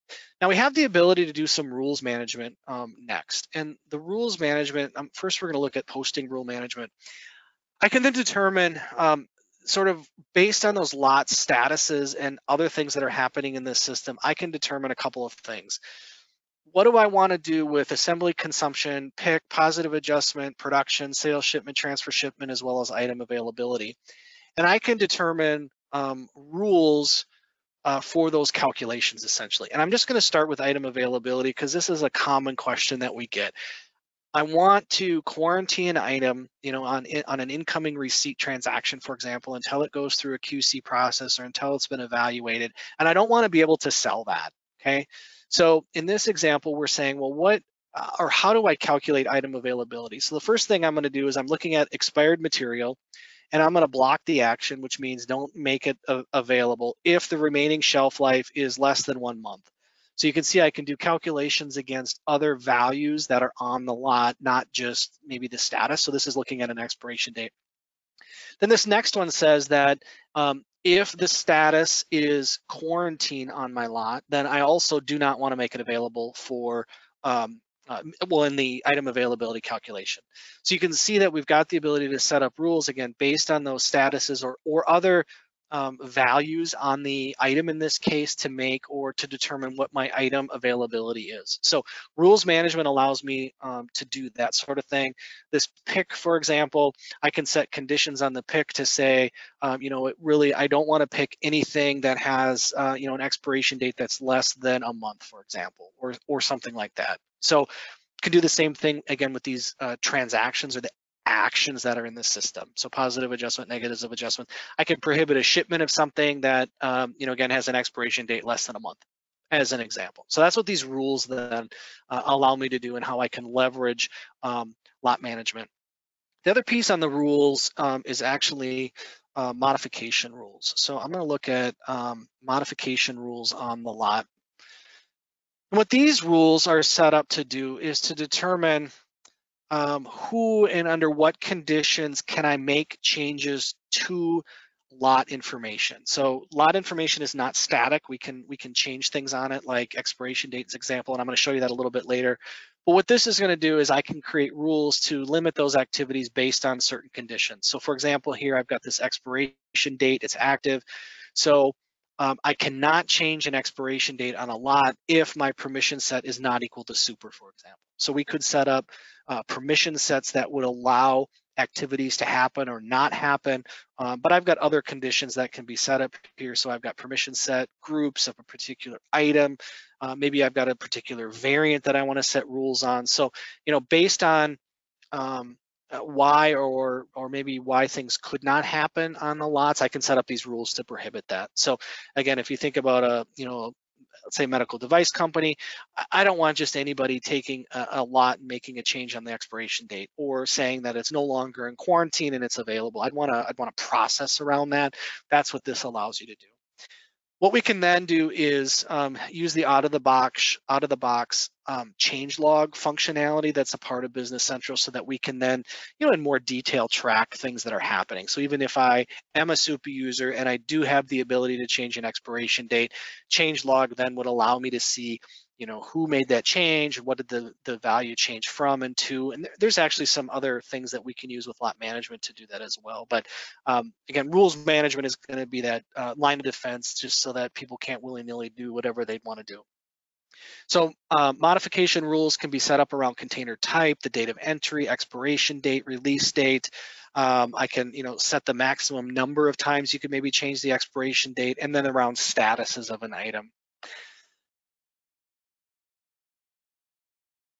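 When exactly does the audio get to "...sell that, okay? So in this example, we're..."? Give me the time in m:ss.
0:43.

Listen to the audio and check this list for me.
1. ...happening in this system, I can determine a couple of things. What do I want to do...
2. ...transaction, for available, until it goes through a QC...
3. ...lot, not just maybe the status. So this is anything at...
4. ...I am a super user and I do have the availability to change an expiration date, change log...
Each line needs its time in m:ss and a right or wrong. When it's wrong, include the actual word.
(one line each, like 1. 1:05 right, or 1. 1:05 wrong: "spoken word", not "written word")
1. 0:13 right
2. 0:38 wrong: "example", not "available"
3. 1:03 wrong: "looking", not "anything"
4. 3:38 wrong: "ability", not "availability".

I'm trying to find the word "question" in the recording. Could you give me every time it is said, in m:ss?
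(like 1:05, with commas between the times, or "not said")
0:32.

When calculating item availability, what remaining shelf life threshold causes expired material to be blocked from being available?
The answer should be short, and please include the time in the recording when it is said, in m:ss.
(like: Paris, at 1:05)
1 month, at 0:58.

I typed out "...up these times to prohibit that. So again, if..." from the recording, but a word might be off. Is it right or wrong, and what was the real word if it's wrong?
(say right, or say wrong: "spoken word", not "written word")
wrong: "rules", not "times".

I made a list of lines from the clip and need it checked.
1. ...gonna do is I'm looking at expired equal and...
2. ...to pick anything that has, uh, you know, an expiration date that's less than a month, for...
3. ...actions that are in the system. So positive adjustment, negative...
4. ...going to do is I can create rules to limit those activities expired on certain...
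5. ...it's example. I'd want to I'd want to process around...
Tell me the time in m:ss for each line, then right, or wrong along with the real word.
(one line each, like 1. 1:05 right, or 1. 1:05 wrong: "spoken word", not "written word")
1. 0:50 wrong: "material", not "equal"
2. 1:41 right
3. 1:51 right
4. 2:33 wrong: "based", not "expired"
5. 3:22 wrong: "available", not "example".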